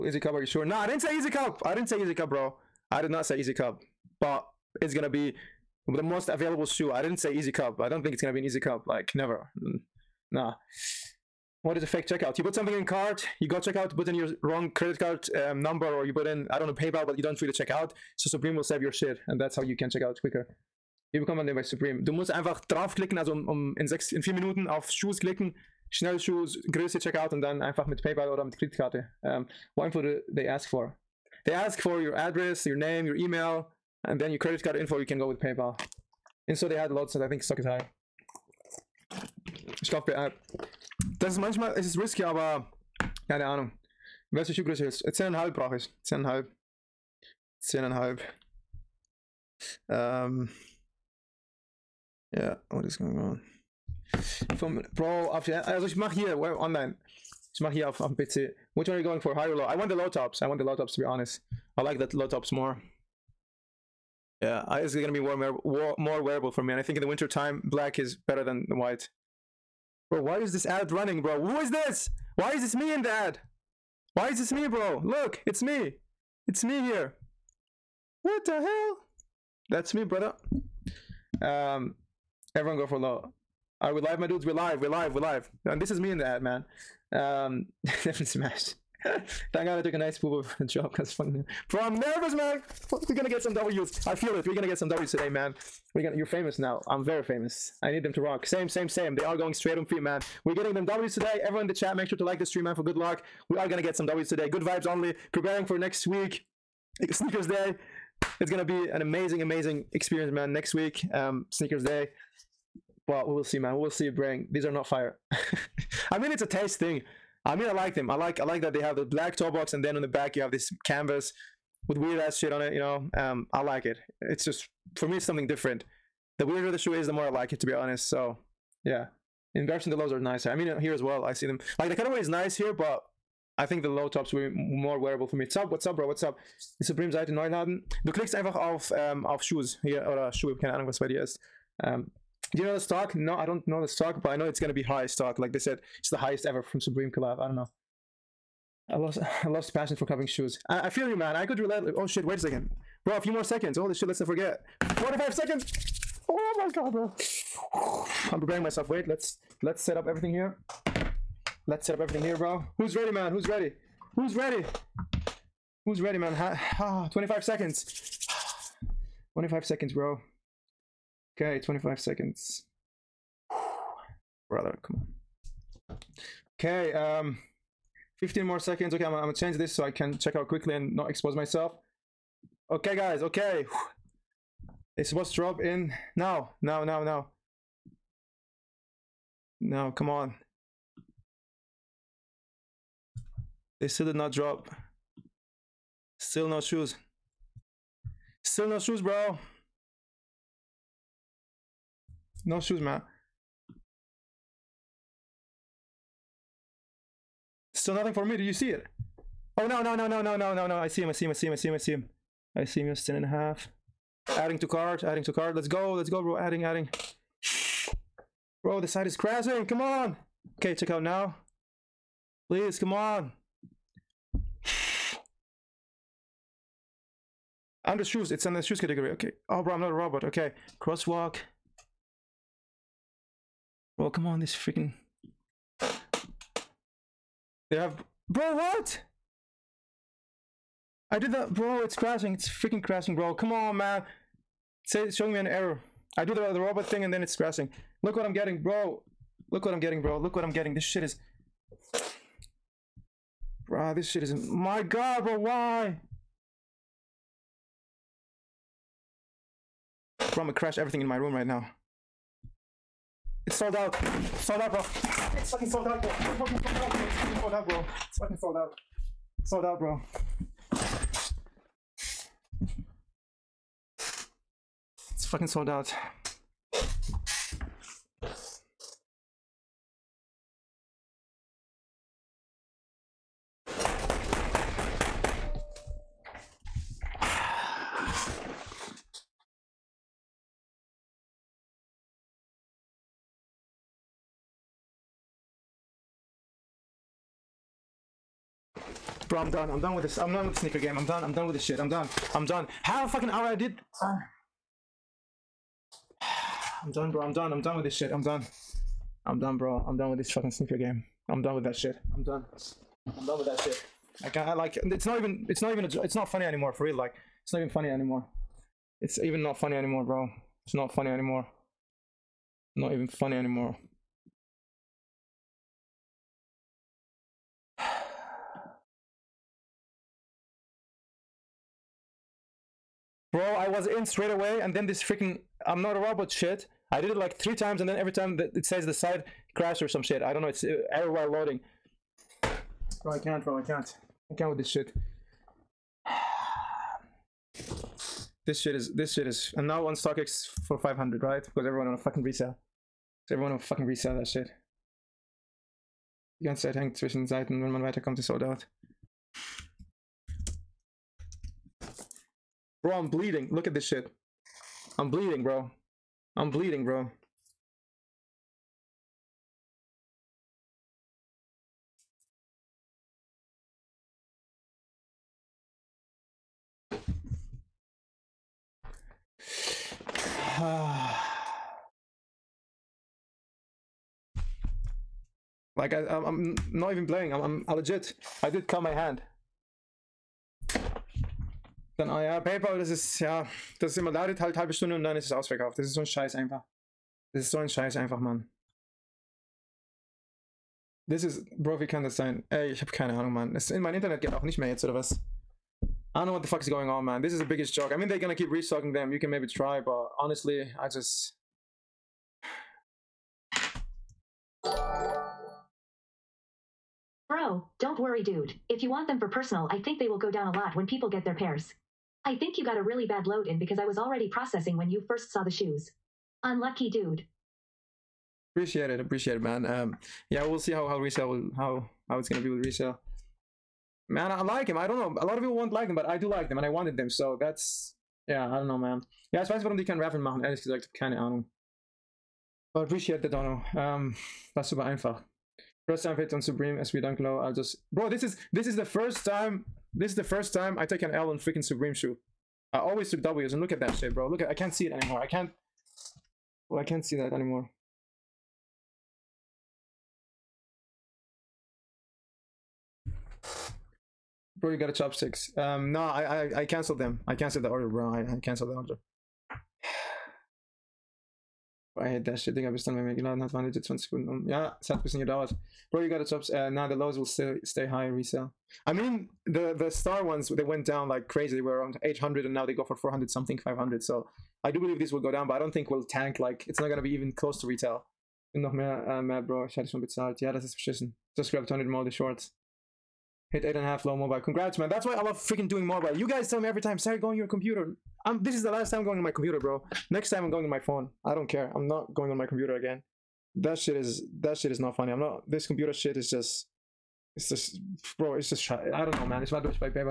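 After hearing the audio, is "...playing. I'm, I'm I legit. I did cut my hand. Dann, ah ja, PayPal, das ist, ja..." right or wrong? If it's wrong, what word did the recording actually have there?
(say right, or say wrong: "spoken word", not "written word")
right.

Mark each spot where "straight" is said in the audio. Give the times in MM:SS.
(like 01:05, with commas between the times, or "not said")
01:39, 05:34.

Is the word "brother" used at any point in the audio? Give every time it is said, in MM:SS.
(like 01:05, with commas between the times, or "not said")
01:20, 02:54.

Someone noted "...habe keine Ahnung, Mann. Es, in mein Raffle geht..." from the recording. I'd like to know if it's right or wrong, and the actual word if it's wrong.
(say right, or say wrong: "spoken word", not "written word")
wrong: "Internet", not "Raffle".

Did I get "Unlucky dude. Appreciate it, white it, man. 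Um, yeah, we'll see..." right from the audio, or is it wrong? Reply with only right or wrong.
wrong.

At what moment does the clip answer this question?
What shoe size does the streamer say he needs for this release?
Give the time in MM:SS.
00:45.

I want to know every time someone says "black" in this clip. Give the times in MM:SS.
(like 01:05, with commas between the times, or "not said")
01:07, 01:59.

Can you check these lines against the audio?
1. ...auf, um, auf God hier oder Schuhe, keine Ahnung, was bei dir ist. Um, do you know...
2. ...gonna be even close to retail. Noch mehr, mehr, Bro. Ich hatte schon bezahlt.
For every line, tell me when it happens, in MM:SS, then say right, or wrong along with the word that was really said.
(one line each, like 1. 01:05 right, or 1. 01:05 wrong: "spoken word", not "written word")
1. 02:18 wrong: "Shoes", not "God"
2. 08:06 right.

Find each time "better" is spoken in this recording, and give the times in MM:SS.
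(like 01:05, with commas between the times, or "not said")
01:08.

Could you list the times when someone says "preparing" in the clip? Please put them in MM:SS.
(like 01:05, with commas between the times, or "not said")
01:45, 02:38.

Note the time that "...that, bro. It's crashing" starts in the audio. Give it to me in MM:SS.
04:01.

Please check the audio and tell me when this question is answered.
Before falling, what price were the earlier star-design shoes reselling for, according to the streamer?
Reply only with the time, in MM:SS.
08:01.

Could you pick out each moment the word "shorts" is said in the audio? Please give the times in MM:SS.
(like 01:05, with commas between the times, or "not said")
08:12.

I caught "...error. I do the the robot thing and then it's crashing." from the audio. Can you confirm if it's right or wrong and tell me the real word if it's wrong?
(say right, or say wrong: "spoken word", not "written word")
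right.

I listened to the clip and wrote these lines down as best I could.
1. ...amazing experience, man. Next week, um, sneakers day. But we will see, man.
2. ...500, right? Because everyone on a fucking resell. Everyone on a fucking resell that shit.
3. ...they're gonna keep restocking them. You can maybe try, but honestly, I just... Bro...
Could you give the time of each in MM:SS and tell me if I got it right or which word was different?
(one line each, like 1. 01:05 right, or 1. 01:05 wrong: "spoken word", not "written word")
1. 01:49 right
2. 05:50 right
3. 06:48 right.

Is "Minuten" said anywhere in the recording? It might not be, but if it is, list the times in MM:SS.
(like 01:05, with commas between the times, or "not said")
00:24.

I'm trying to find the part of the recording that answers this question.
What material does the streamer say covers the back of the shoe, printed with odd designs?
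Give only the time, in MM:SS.
02:00.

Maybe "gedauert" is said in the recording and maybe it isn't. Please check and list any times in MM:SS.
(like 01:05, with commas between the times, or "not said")
07:55.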